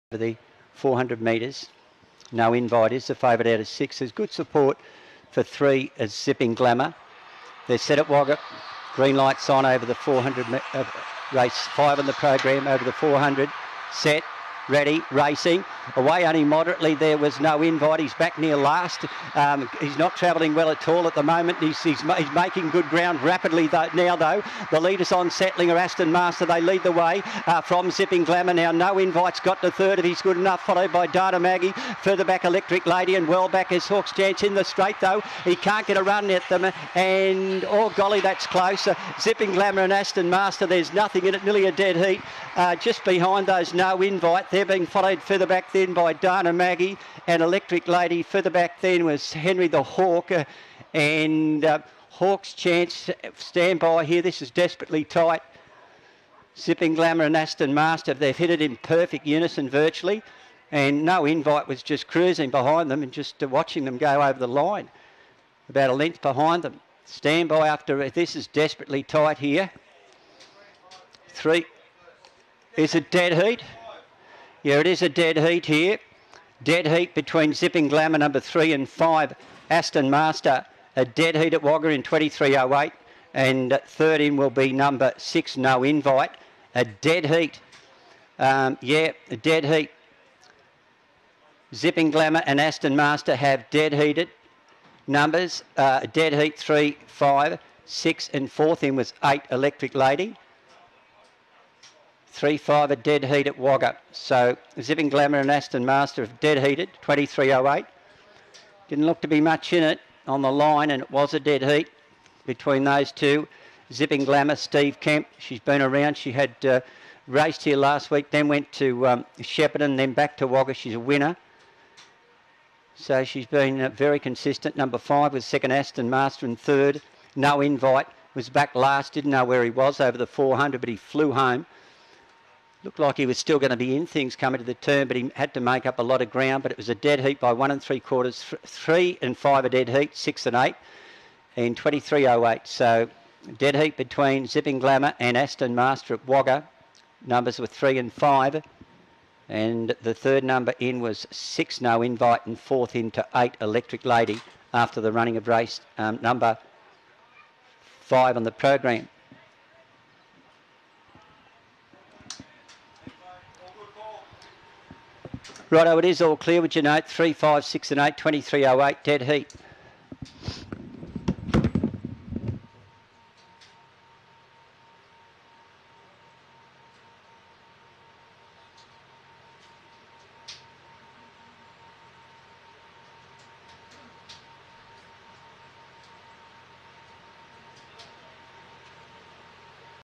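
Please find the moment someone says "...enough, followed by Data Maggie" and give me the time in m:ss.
0:30.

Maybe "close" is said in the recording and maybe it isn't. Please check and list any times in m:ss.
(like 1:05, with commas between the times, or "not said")
0:38.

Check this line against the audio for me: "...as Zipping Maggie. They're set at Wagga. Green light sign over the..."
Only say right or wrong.
wrong.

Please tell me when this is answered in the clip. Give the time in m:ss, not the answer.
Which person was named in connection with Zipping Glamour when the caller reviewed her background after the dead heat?
1:54.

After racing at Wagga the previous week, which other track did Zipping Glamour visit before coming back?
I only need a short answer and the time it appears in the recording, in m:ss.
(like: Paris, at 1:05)
Shepparton, at 1:59.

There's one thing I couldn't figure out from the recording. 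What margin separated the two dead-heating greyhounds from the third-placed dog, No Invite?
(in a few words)
1 and 3/4 lengths.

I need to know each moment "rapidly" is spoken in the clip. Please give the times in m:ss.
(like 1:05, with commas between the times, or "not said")
0:23.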